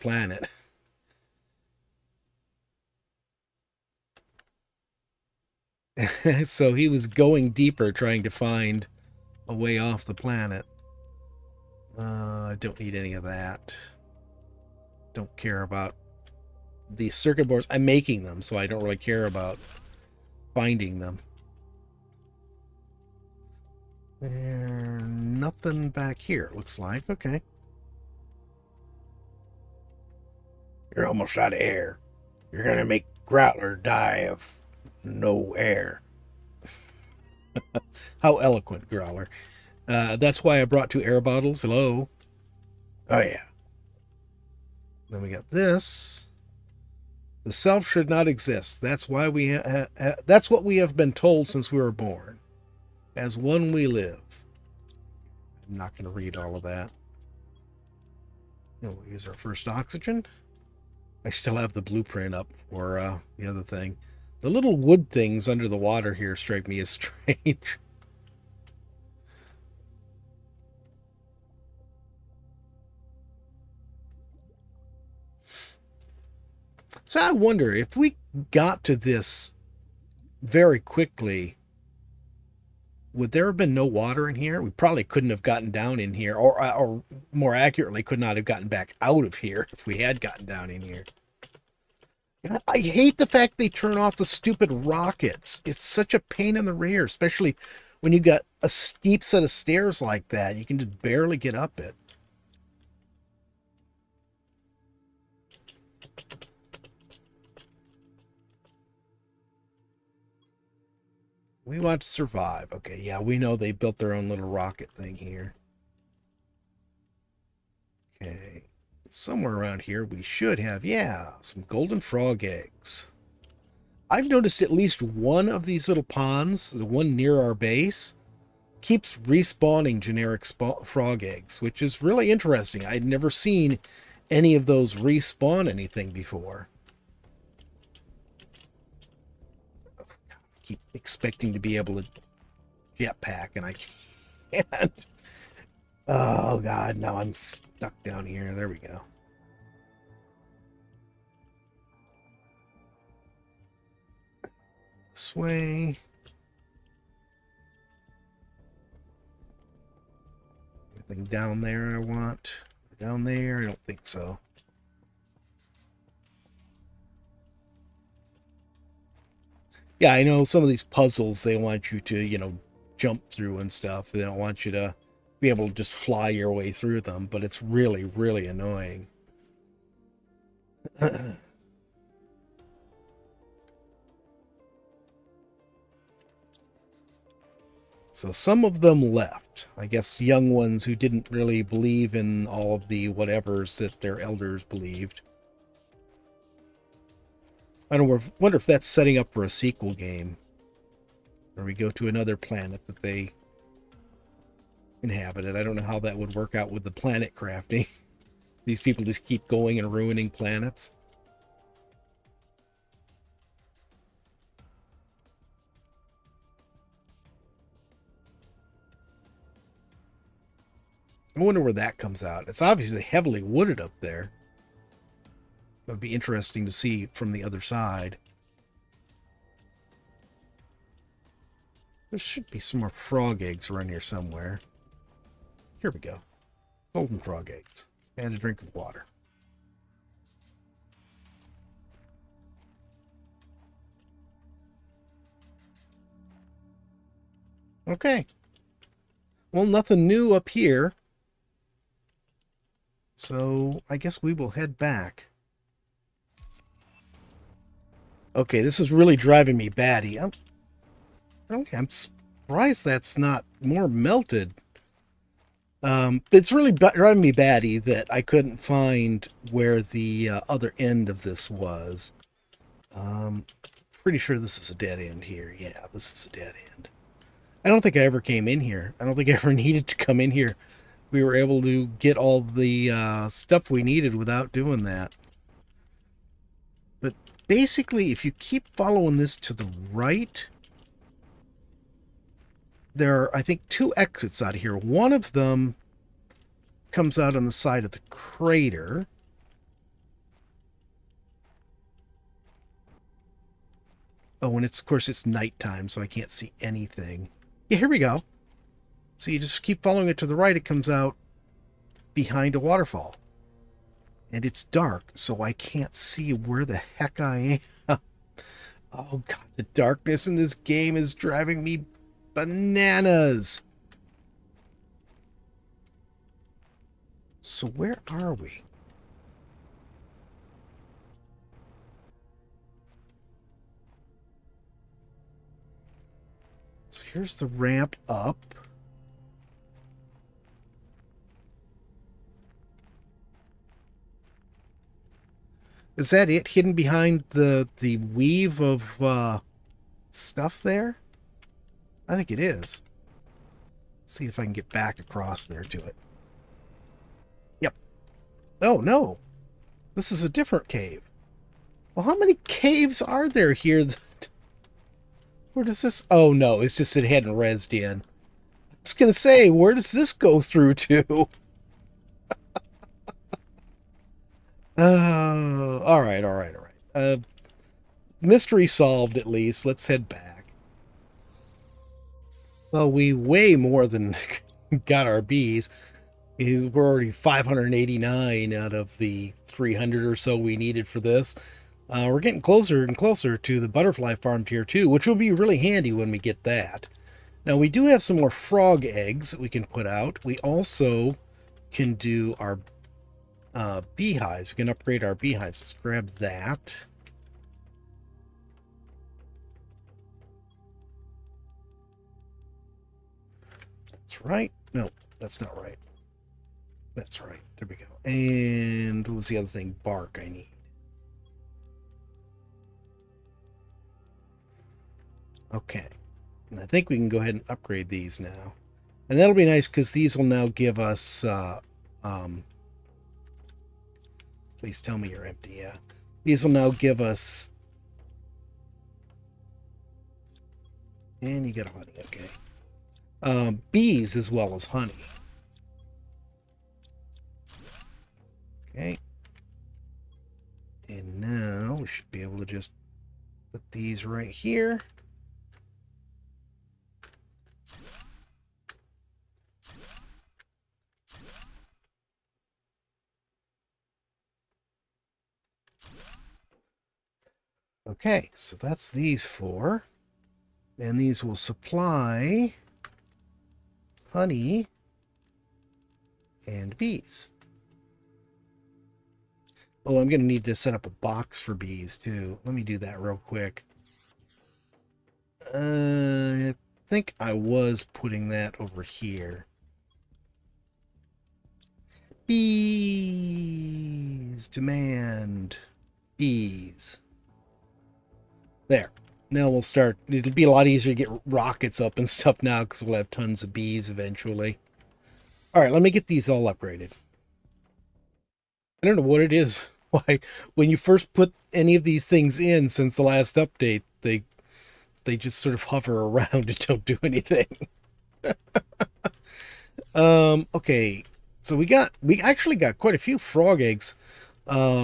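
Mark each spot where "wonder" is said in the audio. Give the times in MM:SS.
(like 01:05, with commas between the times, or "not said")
01:17, 03:18, 03:41.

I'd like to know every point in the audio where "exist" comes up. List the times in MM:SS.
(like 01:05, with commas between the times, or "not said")
00:48.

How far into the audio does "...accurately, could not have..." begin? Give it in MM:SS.
01:27.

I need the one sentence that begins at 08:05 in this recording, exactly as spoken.
Uh, I think I was putting that over here.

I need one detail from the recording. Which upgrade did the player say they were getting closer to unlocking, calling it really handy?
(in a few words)
butterfly farm tier 2.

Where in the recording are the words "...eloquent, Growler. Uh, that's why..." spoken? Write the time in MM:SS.
00:38.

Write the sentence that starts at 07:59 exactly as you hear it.
Oh, I'm going to need to set up a box for bees, too.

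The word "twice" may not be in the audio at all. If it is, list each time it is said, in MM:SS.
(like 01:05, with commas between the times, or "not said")
not said.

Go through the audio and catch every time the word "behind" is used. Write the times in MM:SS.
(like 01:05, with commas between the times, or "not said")
05:12, 05:46.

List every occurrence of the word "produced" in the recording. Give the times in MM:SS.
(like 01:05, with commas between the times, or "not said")
not said.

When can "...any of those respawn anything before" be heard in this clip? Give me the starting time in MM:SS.
02:14.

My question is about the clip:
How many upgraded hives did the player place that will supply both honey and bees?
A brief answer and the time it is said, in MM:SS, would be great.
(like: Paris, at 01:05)
4, at 07:49.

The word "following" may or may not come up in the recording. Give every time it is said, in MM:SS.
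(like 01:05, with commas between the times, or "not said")
04:48, 05:09.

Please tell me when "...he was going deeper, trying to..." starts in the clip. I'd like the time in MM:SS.
00:06.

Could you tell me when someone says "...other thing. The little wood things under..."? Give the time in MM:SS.
01:03.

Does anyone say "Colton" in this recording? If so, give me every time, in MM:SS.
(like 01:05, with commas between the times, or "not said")
not said.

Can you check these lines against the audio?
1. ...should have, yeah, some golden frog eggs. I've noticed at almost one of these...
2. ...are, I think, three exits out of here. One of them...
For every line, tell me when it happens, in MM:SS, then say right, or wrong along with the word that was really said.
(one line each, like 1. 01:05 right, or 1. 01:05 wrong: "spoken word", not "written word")
1. 02:00 wrong: "least", not "almost"
2. 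04:53 wrong: "two", not "three".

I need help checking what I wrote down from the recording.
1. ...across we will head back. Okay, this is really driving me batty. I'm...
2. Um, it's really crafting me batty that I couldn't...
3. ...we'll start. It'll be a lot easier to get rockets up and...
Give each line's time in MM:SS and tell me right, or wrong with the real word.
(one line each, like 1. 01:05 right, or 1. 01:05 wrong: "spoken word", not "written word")
1. 04:13 wrong: "guess", not "across"
2. 04:25 wrong: "driving", not "crafting"
3. 08:19 right.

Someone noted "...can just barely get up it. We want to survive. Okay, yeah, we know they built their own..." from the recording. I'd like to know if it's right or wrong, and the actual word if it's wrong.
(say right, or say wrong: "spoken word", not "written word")
right.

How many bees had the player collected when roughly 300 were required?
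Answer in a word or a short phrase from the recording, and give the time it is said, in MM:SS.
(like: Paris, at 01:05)
589, at 06:27.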